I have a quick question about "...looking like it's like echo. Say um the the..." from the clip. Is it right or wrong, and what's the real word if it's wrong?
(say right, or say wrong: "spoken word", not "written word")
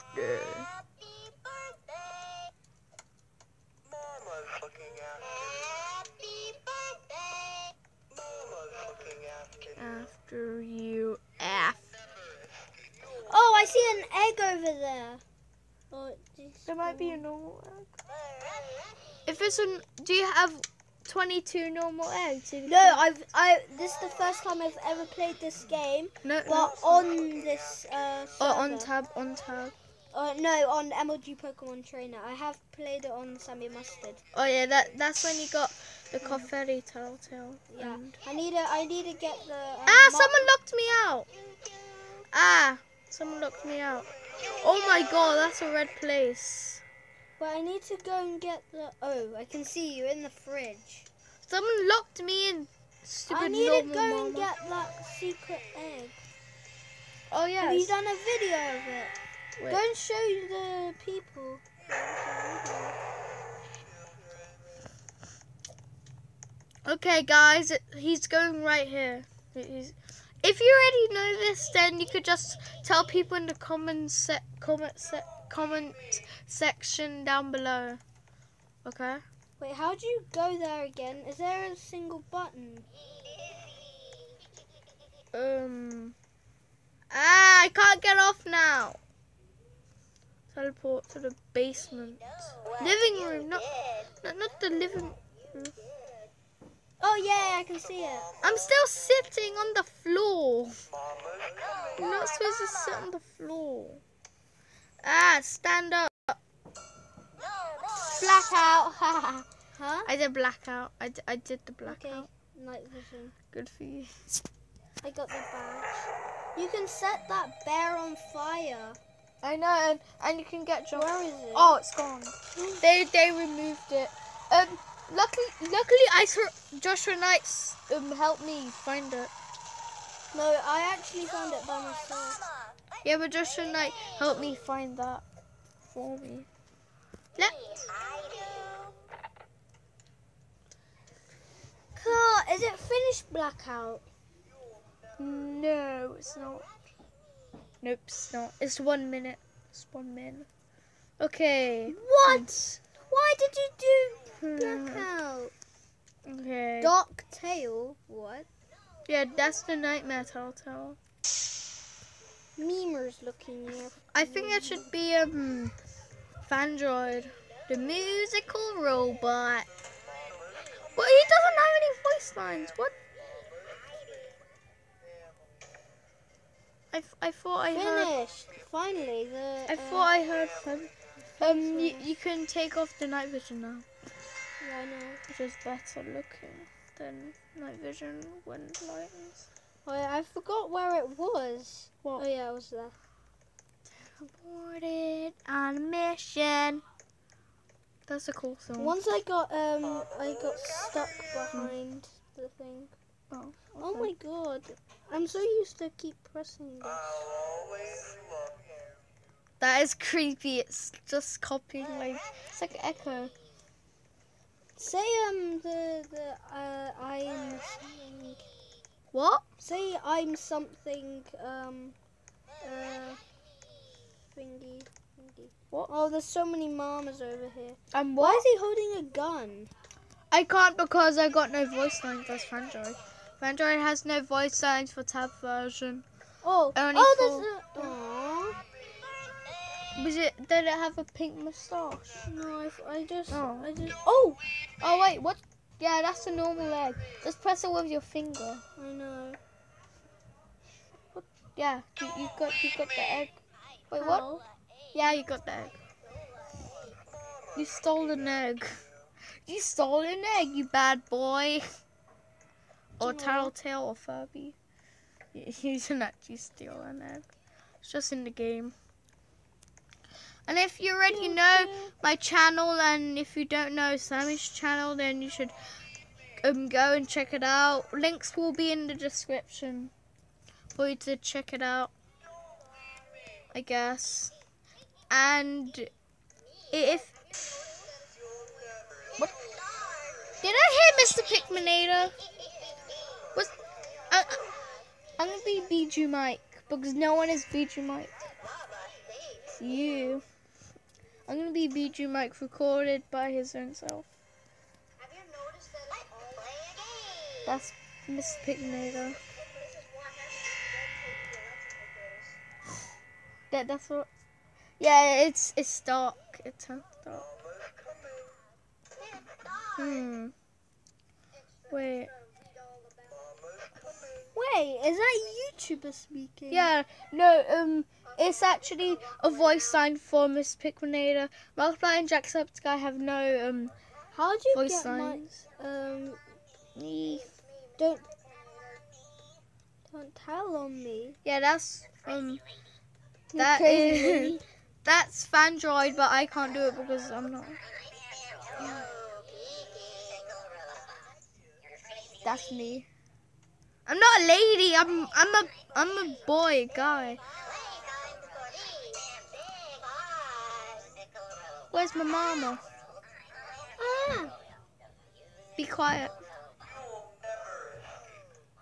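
wrong: "copying", not "looking".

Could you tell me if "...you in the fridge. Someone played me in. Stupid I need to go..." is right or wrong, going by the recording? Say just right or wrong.
wrong.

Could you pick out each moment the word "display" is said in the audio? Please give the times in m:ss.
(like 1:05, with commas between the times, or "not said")
not said.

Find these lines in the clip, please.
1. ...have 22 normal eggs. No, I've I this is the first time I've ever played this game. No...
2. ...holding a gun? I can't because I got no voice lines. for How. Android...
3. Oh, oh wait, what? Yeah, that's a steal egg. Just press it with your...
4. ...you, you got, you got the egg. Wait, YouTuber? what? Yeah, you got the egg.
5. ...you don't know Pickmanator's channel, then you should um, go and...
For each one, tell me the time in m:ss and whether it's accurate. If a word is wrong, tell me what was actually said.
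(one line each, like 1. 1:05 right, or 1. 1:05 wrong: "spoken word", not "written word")
1. 0:20 right
2. 3:48 wrong: "Android", not "How"
3. 4:04 wrong: "normal", not "steal"
4. 4:11 wrong: "How", not "YouTuber"
5. 4:33 wrong: "Sammy", not "Pickmanator".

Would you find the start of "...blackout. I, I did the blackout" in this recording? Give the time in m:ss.
1:50.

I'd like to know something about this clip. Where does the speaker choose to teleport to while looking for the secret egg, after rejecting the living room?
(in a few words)
the basement.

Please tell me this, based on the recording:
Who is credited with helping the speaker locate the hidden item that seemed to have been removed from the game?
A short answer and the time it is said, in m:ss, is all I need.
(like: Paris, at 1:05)
Joshua Knights, at 2:06.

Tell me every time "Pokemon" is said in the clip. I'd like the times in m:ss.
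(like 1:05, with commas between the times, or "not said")
0:31.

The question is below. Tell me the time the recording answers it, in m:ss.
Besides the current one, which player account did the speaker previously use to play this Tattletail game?
0:33.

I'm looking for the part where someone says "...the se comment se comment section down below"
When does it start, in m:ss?
1:13.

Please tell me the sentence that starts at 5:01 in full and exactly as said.
I'm gonna be BijuuMike recorded by his own self.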